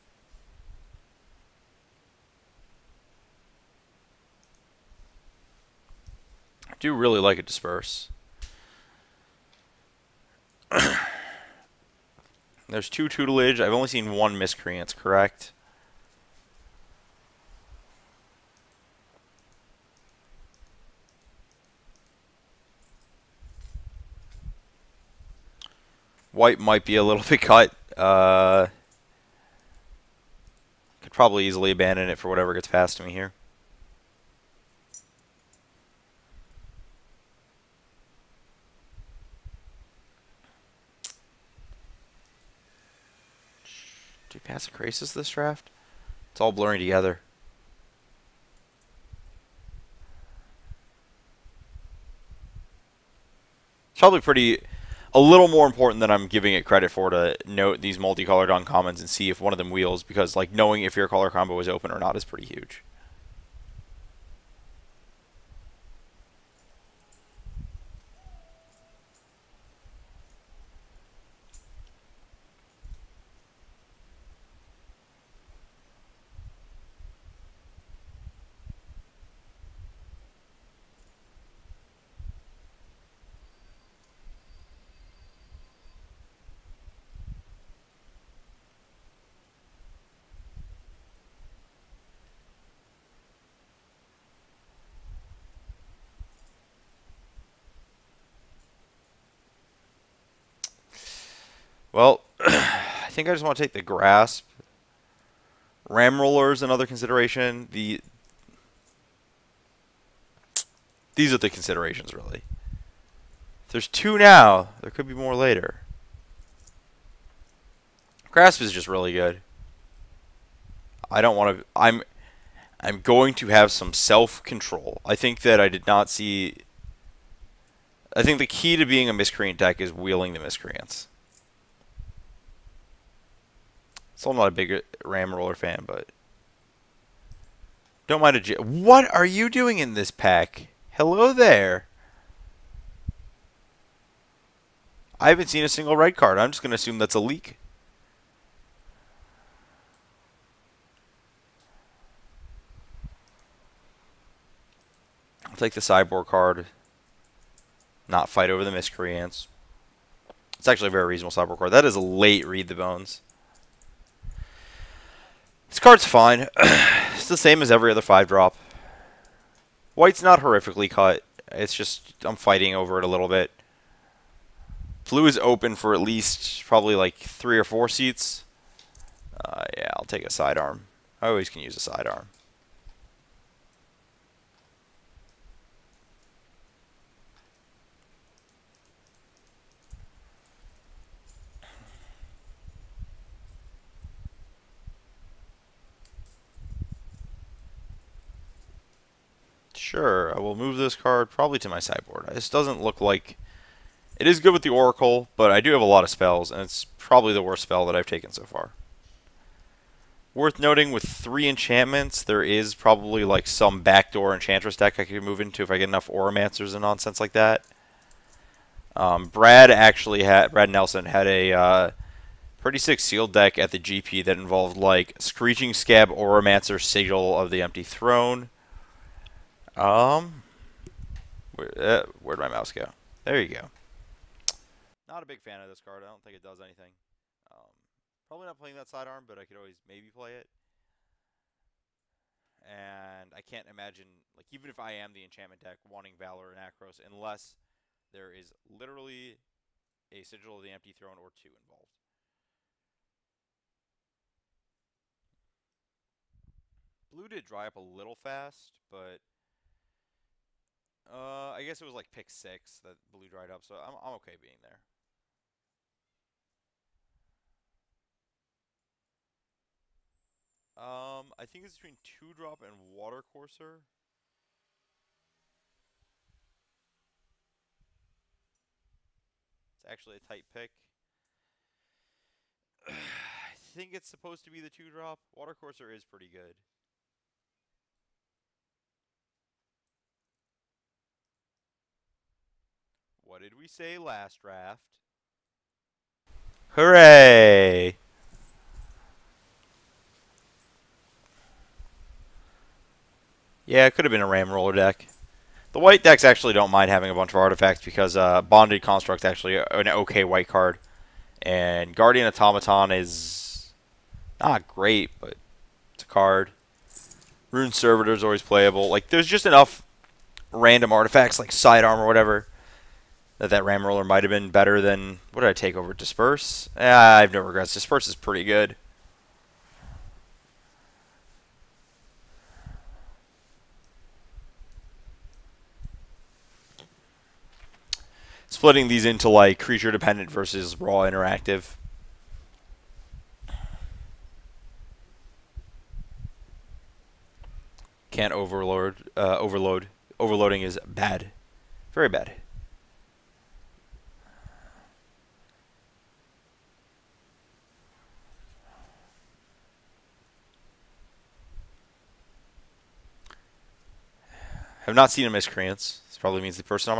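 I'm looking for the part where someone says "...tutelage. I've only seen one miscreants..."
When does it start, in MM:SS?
00:13.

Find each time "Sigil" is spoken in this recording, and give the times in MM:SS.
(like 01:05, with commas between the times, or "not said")
03:46, 04:10.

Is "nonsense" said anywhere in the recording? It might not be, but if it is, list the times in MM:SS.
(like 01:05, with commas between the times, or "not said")
03:36.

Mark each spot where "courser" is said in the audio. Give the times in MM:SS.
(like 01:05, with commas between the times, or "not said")
04:33, 04:45.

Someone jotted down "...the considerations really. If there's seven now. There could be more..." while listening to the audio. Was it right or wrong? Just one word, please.
wrong.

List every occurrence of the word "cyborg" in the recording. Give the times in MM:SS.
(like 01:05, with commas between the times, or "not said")
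02:35, 02:41.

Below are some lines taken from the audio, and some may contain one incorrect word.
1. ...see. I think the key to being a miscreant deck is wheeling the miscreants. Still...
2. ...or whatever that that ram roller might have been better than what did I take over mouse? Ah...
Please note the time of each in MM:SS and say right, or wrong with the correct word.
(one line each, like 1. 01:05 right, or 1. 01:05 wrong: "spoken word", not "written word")
1. 02:06 right
2. 05:21 wrong: "disperse", not "mouse".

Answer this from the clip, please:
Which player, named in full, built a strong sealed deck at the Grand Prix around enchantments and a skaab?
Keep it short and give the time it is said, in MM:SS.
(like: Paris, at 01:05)
Brad Nelson, at 03:40.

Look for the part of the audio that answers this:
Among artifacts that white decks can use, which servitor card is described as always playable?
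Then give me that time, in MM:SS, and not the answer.
05:17.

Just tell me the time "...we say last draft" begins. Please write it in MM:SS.
04:53.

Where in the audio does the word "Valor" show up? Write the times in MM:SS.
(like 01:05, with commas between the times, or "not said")
04:06.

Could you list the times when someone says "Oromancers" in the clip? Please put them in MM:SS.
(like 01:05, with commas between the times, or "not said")
03:36, 03:46.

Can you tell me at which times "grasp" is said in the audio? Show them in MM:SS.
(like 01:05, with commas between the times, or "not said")
01:43, 01:58.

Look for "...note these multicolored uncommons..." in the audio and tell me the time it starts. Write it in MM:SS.
00:57.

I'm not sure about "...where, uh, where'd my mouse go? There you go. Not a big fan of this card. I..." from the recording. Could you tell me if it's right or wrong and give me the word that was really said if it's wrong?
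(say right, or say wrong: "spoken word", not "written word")
right.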